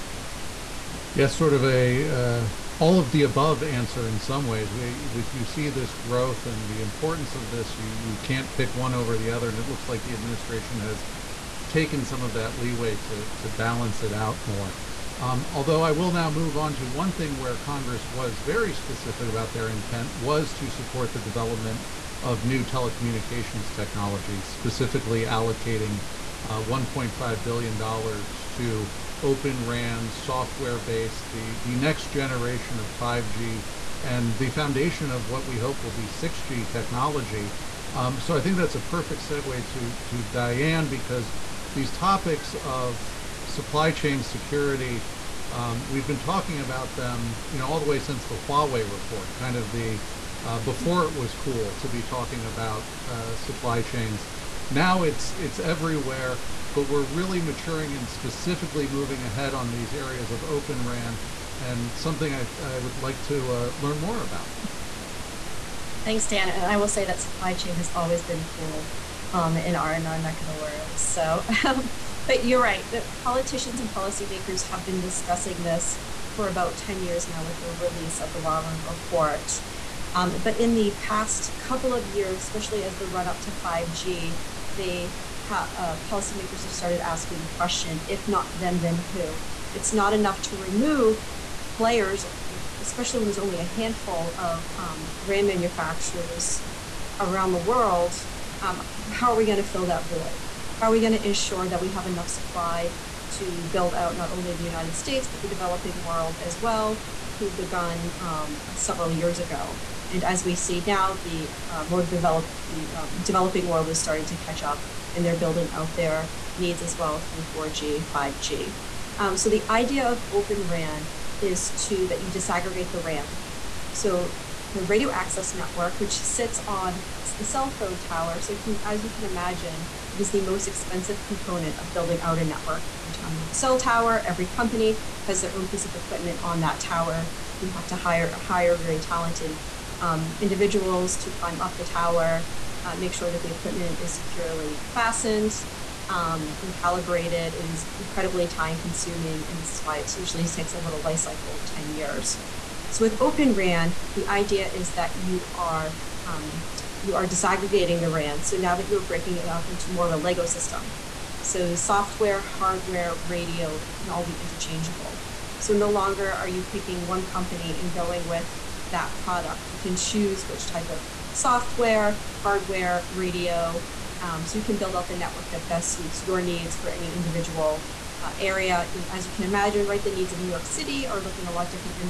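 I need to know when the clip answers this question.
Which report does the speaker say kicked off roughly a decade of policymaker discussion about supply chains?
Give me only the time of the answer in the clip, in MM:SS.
01:18.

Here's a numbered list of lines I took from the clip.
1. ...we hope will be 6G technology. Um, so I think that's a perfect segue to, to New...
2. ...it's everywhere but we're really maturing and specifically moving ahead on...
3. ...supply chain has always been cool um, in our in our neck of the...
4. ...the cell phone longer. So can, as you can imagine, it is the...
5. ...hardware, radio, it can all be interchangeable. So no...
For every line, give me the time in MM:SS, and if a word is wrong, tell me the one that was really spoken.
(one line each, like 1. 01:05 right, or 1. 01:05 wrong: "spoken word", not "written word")
1. 00:35 wrong: "Diane", not "New"
2. 00:55 right
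3. 01:07 right
4. 02:07 wrong: "tower", not "longer"
5. 02:42 right.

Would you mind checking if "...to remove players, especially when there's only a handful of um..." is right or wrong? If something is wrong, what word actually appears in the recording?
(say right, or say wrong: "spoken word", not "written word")
right.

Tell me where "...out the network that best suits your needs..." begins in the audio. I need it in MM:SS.
02:54.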